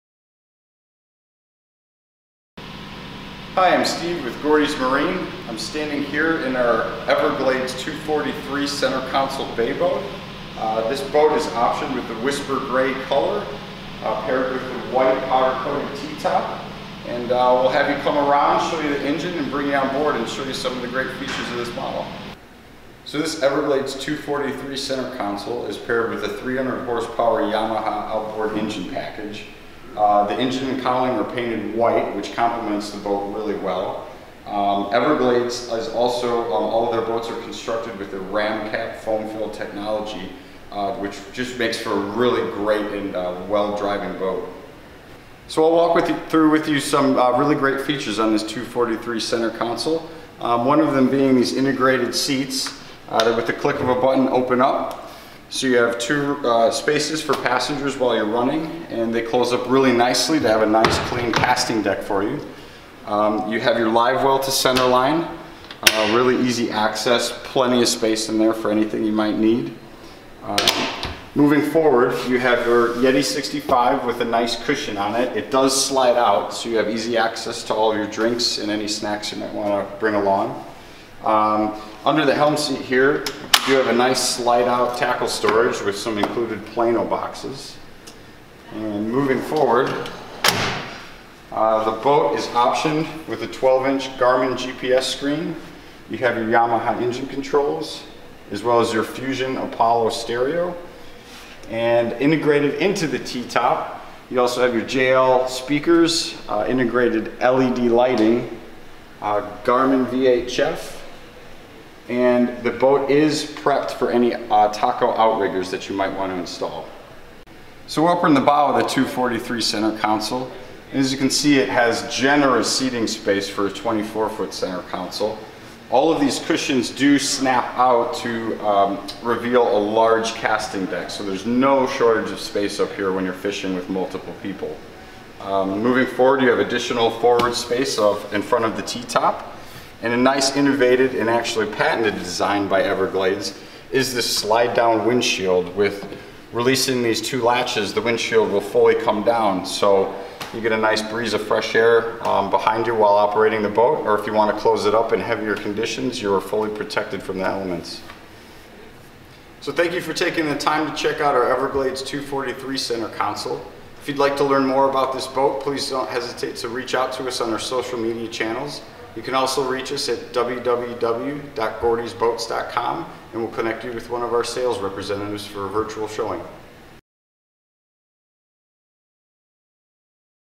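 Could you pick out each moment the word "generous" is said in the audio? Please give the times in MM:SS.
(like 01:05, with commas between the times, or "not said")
02:02.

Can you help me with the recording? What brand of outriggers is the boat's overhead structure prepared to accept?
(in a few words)
TACO.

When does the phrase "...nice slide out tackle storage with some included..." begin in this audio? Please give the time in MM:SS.
01:23.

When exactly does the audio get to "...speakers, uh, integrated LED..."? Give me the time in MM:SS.
01:45.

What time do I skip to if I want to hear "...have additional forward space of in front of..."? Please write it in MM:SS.
02:16.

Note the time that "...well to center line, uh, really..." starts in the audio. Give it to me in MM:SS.
01:04.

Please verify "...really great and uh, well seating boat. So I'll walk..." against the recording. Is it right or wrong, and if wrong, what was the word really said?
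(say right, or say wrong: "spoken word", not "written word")
wrong: "driving", not "seating".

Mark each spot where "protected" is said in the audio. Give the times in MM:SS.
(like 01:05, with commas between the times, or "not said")
02:36.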